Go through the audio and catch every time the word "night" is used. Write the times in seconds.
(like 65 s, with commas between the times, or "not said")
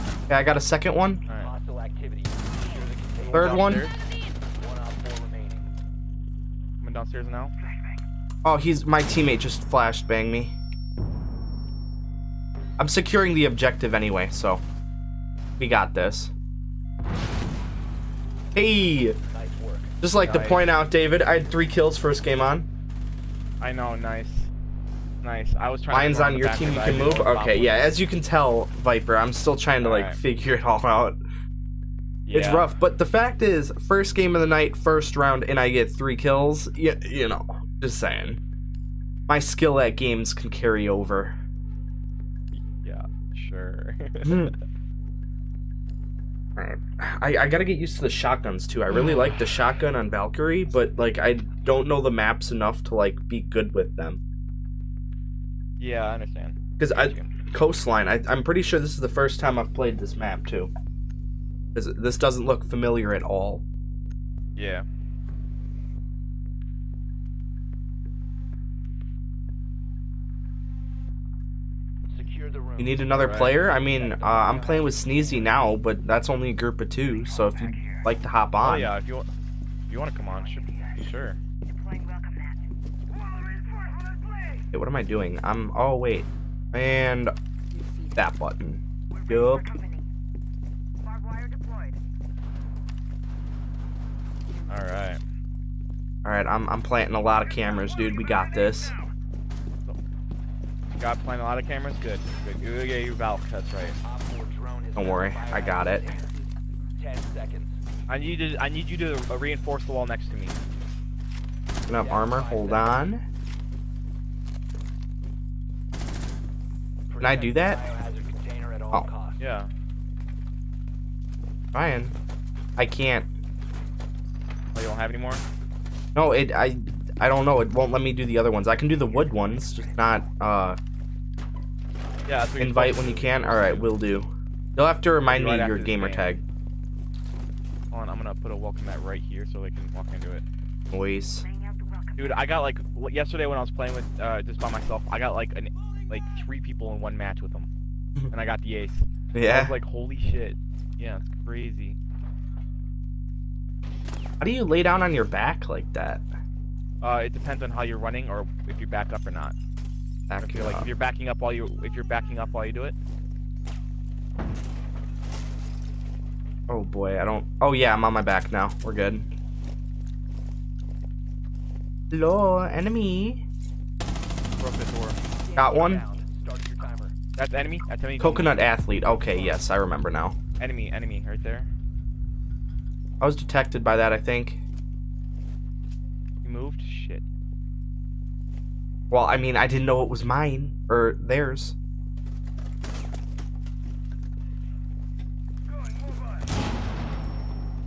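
34 s.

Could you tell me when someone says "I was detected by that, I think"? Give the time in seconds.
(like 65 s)
183 s.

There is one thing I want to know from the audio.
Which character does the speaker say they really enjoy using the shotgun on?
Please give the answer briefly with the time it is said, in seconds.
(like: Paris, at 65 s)
Valkyrie, at 50 s.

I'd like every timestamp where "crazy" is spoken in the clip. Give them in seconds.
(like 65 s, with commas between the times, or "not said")
151 s.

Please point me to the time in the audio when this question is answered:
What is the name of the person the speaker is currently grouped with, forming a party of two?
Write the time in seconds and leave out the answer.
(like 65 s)
74 s.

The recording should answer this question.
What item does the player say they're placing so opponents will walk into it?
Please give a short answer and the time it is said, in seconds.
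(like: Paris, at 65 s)
welcome mat, at 138 s.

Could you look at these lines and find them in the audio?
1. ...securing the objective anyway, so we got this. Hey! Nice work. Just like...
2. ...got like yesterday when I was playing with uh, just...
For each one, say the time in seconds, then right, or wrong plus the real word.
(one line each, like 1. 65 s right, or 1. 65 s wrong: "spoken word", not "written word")
1. 12 s right
2. 142 s right.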